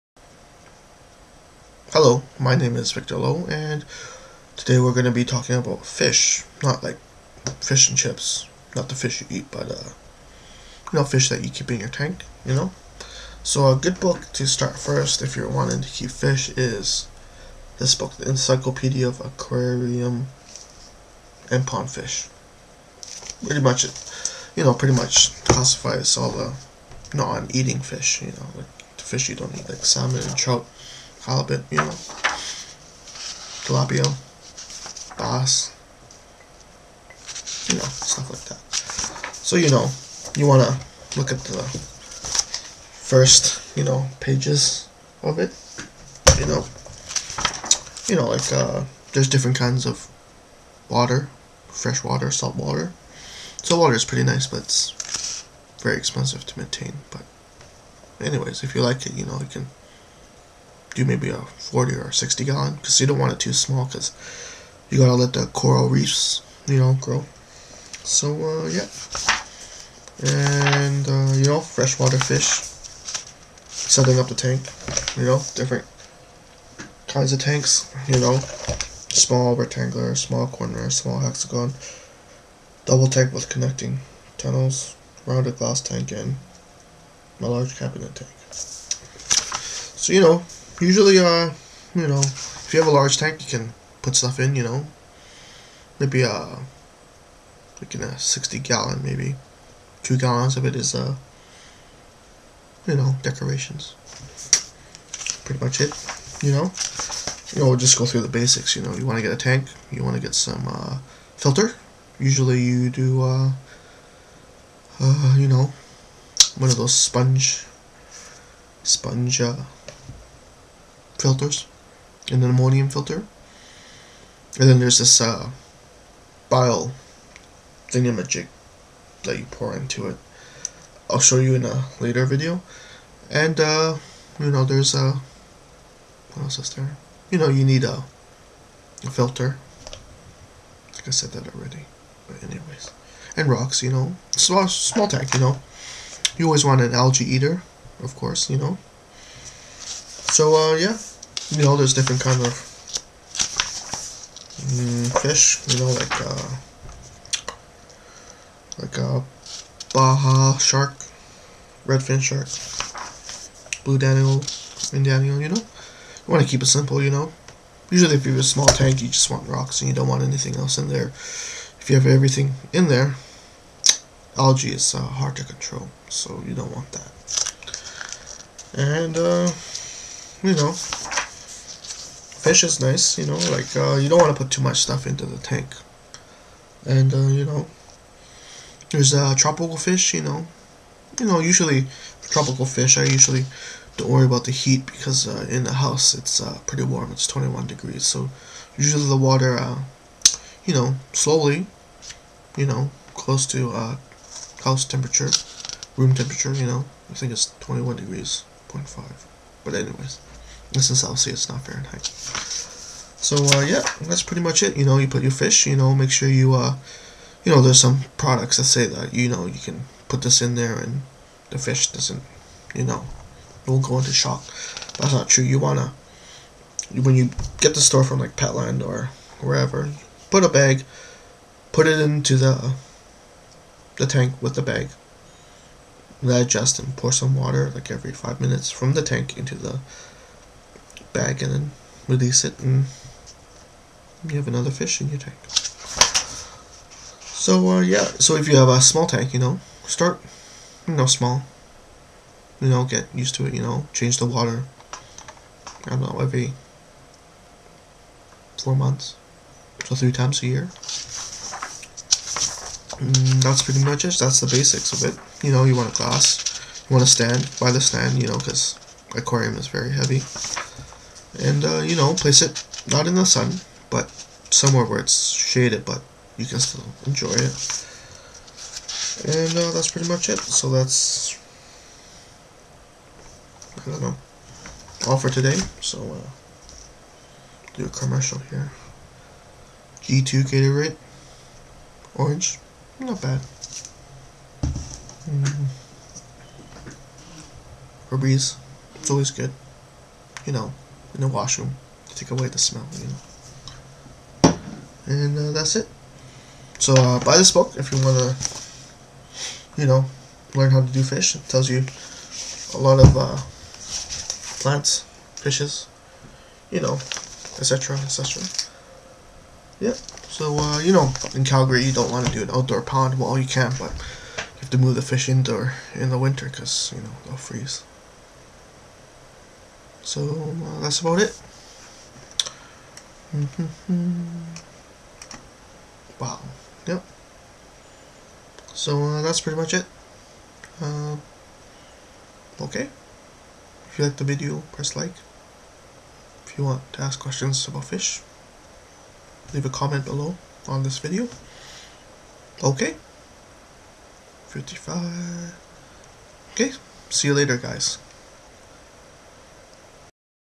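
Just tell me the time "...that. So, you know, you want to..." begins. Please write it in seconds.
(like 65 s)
38 s.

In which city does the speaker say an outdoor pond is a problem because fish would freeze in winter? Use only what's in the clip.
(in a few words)
Calgary.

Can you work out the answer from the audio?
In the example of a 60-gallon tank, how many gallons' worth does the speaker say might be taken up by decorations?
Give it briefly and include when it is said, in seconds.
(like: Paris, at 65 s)
2, at 100 s.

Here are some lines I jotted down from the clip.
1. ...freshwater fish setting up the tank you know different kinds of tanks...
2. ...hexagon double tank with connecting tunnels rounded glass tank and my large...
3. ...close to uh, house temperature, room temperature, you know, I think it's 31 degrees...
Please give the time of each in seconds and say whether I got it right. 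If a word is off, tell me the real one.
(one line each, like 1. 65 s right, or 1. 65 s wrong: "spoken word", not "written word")
1. 71 s right
2. 81 s right
3. 203 s wrong: "21", not "31".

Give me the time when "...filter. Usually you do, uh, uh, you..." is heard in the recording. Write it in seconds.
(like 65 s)
111 s.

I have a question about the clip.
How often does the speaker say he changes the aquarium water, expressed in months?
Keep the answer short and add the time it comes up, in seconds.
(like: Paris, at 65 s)
Every 4 months, at 256 s.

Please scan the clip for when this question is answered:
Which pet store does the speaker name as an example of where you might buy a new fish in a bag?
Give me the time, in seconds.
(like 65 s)
228 s.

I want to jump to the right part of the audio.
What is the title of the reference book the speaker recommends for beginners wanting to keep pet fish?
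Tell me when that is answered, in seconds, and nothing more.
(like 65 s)
18 s.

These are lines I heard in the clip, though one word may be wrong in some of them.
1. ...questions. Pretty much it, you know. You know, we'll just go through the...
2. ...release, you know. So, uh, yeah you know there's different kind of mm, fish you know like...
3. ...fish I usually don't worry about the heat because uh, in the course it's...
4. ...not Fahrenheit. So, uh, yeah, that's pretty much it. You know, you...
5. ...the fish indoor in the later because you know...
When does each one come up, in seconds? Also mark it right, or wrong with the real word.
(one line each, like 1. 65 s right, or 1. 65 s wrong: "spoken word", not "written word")
1. 103 s wrong: "decorations", not "questions"
2. 148 s wrong: "course", not "release"
3. 192 s wrong: "house", not "course"
4. 211 s right
5. 324 s wrong: "winter", not "later".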